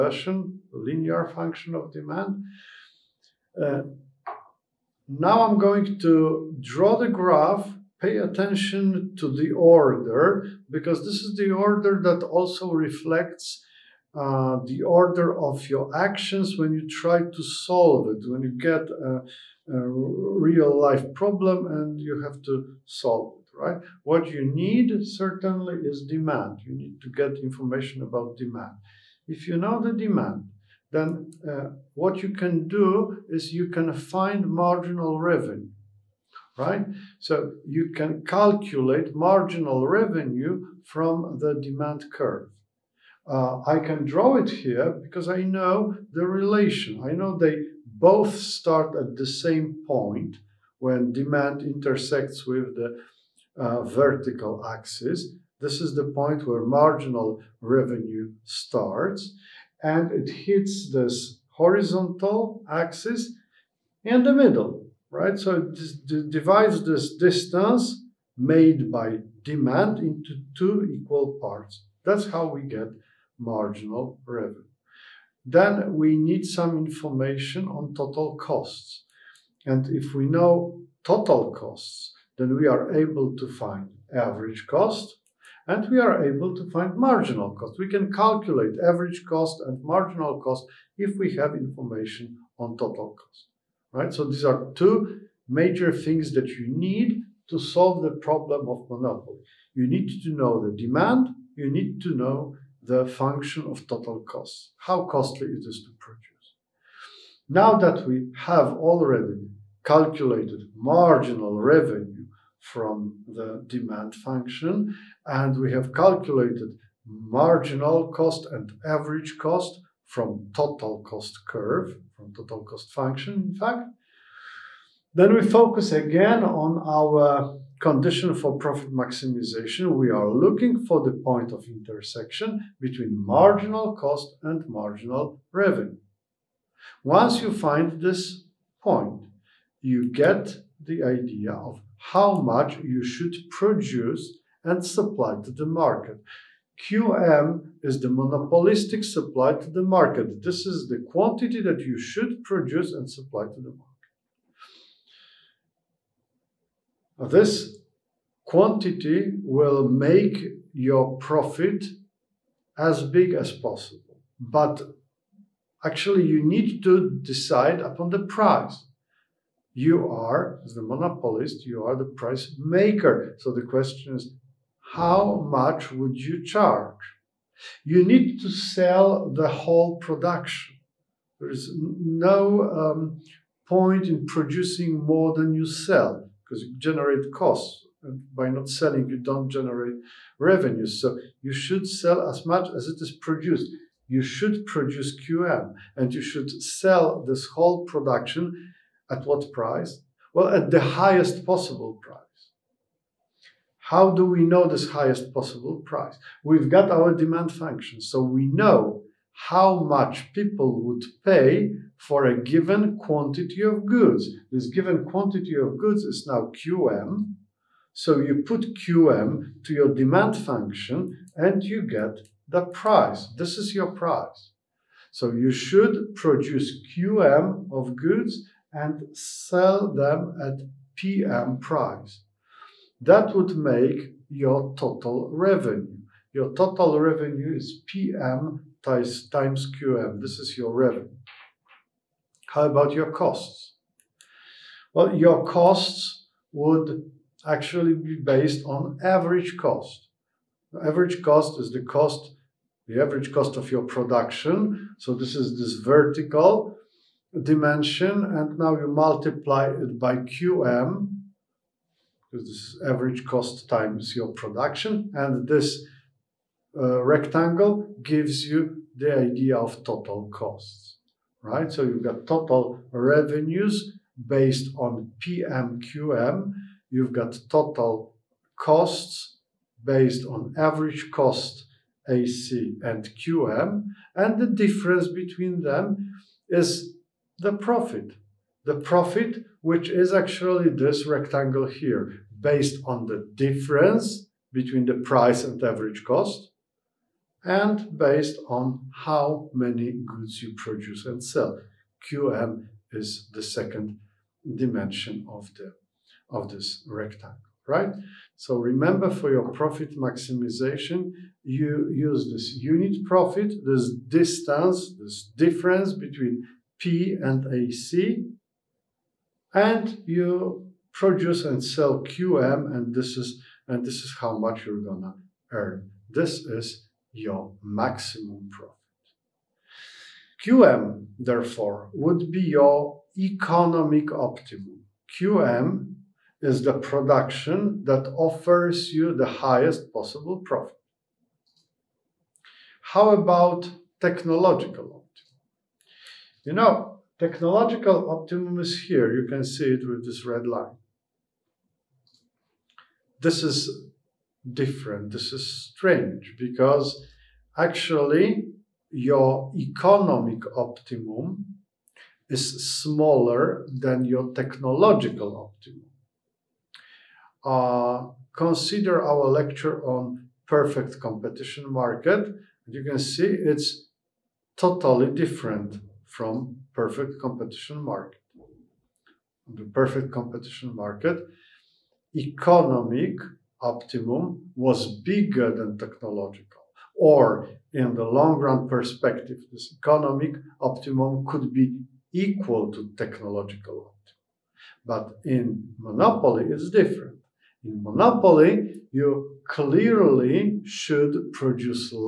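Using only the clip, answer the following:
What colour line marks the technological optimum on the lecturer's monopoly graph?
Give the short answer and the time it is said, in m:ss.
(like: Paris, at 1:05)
Red, at 5:50.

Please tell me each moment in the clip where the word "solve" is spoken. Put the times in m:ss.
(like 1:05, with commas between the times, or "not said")
0:17, 0:22, 1:37.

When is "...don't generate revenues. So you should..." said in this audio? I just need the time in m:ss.
3:09.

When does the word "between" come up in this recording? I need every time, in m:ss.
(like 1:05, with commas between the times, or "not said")
2:12, 4:45, 4:54, 5:15.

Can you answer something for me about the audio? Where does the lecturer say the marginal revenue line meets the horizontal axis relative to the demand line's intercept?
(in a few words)
In the middle.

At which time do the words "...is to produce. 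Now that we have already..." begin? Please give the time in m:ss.
1:45.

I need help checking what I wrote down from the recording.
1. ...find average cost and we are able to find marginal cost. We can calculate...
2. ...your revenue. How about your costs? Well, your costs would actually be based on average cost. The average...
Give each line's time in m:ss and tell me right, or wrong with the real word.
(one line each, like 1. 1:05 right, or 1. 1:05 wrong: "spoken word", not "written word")
1. 1:23 right
2. 4:00 right.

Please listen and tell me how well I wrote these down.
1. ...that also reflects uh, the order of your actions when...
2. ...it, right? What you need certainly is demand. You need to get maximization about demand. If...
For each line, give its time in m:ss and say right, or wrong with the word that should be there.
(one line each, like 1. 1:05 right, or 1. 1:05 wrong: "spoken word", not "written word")
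1. 0:12 right
2. 0:23 wrong: "information", not "maximization".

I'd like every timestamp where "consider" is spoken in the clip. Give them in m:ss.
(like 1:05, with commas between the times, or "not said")
6:08.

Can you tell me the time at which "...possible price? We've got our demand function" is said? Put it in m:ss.
3:25.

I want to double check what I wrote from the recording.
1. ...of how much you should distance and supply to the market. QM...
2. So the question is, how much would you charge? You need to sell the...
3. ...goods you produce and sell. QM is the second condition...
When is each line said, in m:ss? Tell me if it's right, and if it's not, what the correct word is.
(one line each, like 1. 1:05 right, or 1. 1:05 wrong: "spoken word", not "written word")
1. 2:21 wrong: "produce", not "distance"
2. 2:53 right
3. 5:00 wrong: "dimension", not "condition".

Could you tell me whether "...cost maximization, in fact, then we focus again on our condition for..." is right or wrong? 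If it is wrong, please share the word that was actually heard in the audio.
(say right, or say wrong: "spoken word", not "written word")
wrong: "function", not "maximization".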